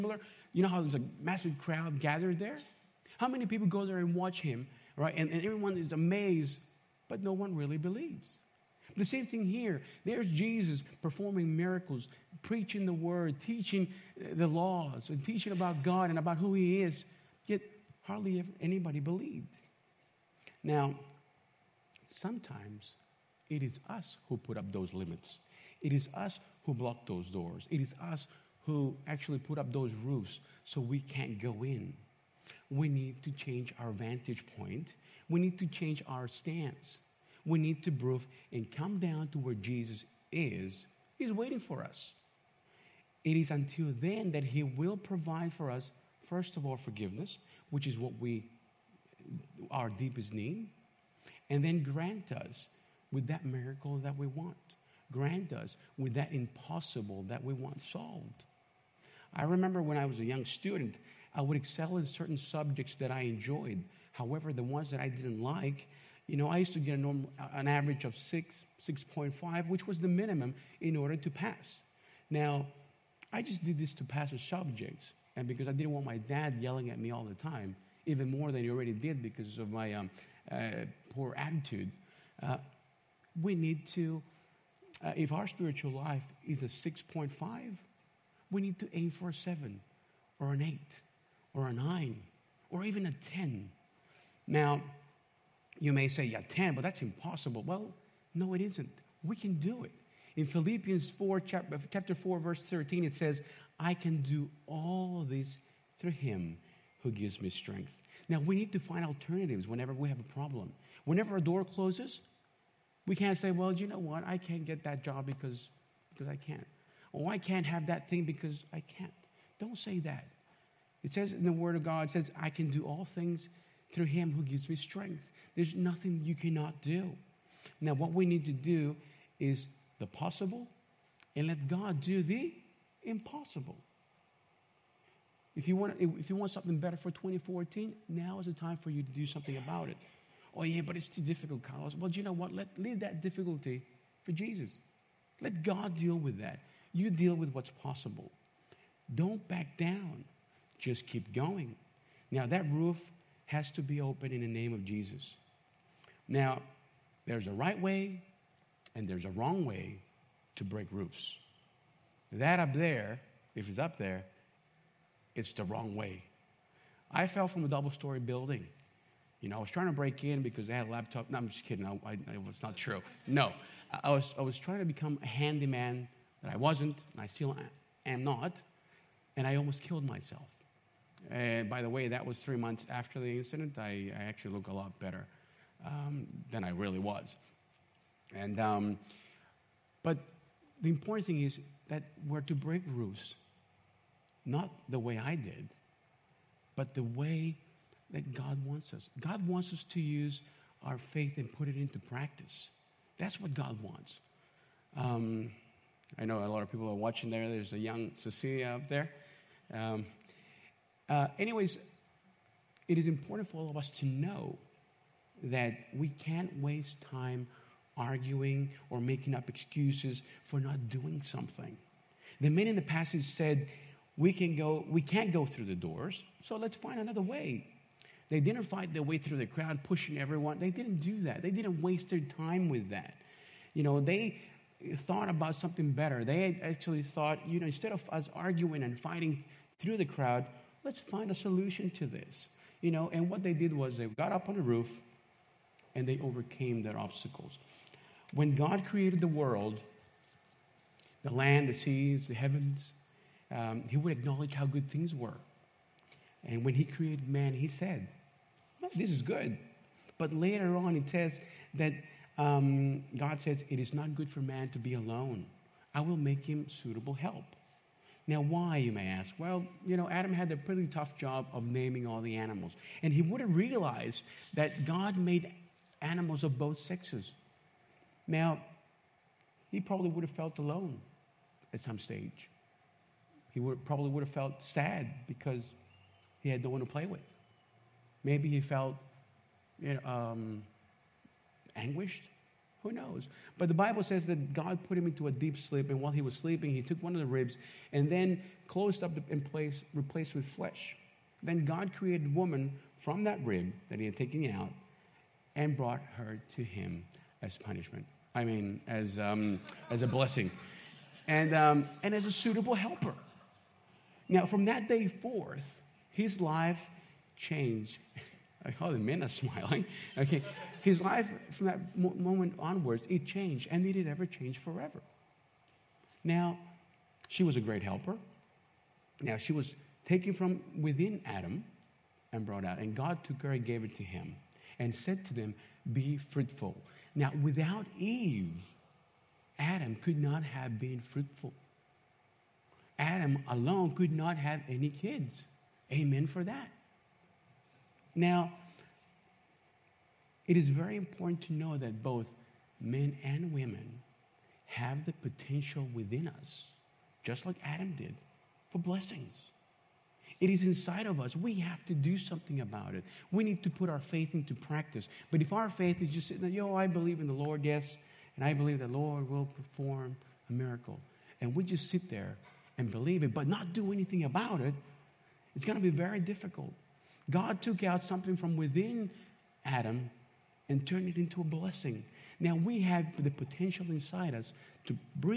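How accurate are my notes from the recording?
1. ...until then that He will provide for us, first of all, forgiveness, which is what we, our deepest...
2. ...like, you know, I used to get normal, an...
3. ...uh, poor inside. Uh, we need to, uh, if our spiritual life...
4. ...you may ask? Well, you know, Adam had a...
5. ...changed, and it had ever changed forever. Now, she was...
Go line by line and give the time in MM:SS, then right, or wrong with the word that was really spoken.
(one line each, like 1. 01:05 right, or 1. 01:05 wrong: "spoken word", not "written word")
1. 00:43 right
2. 01:05 right
3. 01:20 wrong: "attitude", not "inside"
4. 04:28 right
5. 05:23 right.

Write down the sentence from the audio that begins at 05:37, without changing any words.
Now, without Eve, Adam could not have been fruitful.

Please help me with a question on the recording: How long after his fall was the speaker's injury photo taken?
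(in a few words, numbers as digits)
three months.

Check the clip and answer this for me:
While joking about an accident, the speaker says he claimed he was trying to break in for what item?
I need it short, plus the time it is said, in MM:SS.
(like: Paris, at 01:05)
a laptop, at 02:50.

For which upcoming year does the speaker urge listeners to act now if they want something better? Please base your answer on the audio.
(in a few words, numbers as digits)
2014.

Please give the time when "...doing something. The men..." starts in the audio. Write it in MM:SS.
03:40.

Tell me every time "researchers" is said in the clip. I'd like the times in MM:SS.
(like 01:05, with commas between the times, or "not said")
not said.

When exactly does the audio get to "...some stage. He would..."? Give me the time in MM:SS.
04:41.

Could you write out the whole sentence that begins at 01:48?
Now, we need to find alternatives whenever we have a problem.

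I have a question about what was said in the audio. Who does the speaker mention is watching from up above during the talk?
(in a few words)
Cecilia.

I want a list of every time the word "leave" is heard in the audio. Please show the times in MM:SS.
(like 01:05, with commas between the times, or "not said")
02:22.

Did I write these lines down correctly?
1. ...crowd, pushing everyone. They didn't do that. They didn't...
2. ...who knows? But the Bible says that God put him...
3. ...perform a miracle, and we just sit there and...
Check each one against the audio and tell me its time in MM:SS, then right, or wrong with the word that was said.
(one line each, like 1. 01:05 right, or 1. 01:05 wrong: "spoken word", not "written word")
1. 03:49 right
2. 04:52 right
3. 06:09 right.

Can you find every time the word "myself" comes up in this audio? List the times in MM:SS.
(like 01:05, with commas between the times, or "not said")
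03:00.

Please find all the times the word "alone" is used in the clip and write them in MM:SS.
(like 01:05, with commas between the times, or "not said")
04:24, 04:40, 05:43.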